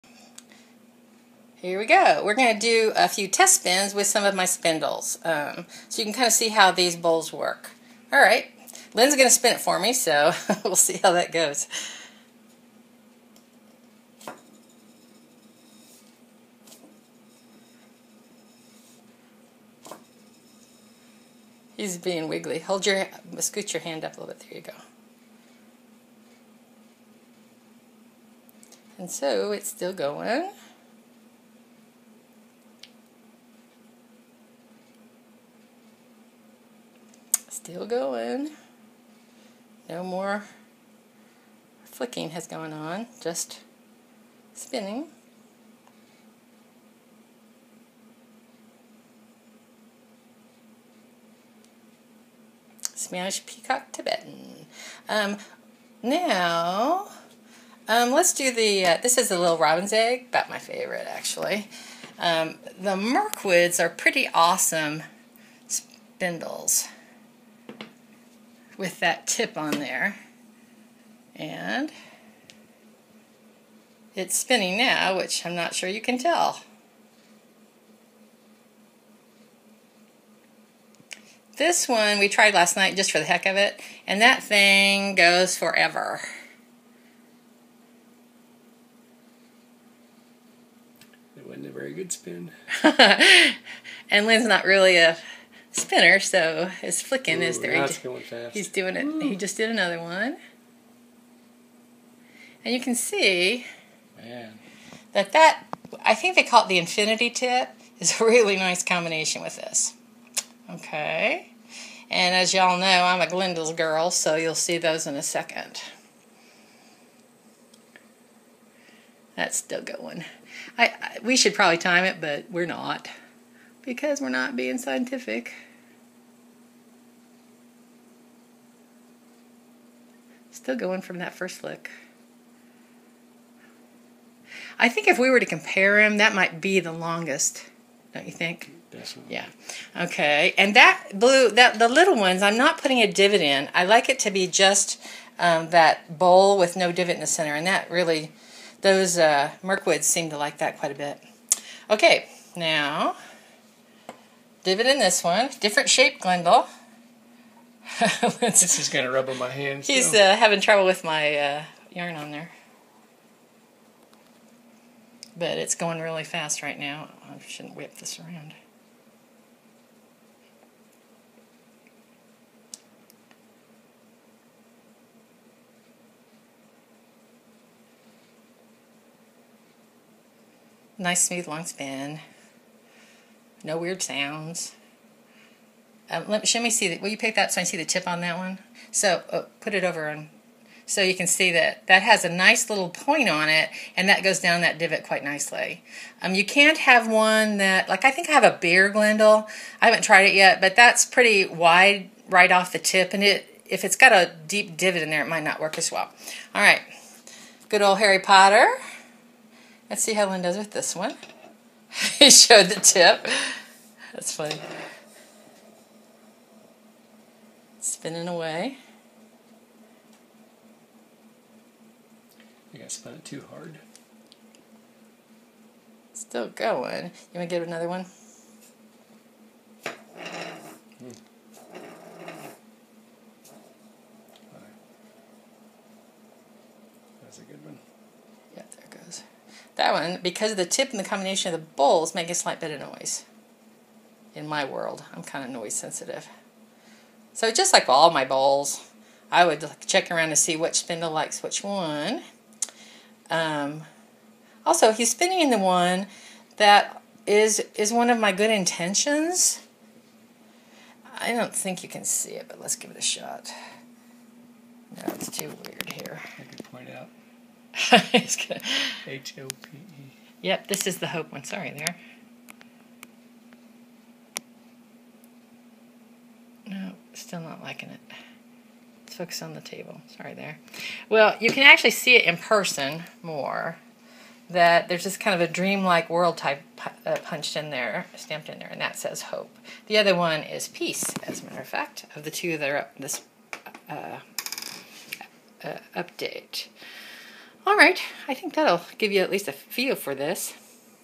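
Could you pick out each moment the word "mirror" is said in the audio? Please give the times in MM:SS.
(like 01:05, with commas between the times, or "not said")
not said.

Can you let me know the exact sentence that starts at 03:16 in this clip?
Um, you can't have one that, like I think I have a beer glendal.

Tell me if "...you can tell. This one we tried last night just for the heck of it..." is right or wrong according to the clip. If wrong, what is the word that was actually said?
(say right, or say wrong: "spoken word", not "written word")
right.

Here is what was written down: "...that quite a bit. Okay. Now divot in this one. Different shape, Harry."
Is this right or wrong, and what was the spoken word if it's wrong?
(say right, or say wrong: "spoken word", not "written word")
wrong: "Glendale", not "Harry".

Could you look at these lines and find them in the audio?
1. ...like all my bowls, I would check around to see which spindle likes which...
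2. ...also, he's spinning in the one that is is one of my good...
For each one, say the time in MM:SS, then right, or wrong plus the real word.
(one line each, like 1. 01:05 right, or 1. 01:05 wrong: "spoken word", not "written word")
1. 04:07 right
2. 04:14 right.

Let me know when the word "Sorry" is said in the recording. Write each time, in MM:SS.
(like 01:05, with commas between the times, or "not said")
04:31, 04:40.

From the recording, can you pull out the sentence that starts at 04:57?
All right, I think that'll give you at least a feel for this.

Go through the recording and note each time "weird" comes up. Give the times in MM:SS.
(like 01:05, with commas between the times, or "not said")
03:03, 04:25.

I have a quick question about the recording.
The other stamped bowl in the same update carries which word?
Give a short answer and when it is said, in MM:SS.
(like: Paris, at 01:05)
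peace, at 04:50.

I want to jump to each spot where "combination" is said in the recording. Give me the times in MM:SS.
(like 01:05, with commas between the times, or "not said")
01:48, 04:01.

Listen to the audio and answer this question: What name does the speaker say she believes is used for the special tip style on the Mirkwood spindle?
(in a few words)
infinity tip.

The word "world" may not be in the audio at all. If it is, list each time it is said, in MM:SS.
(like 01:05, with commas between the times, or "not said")
04:04, 04:46.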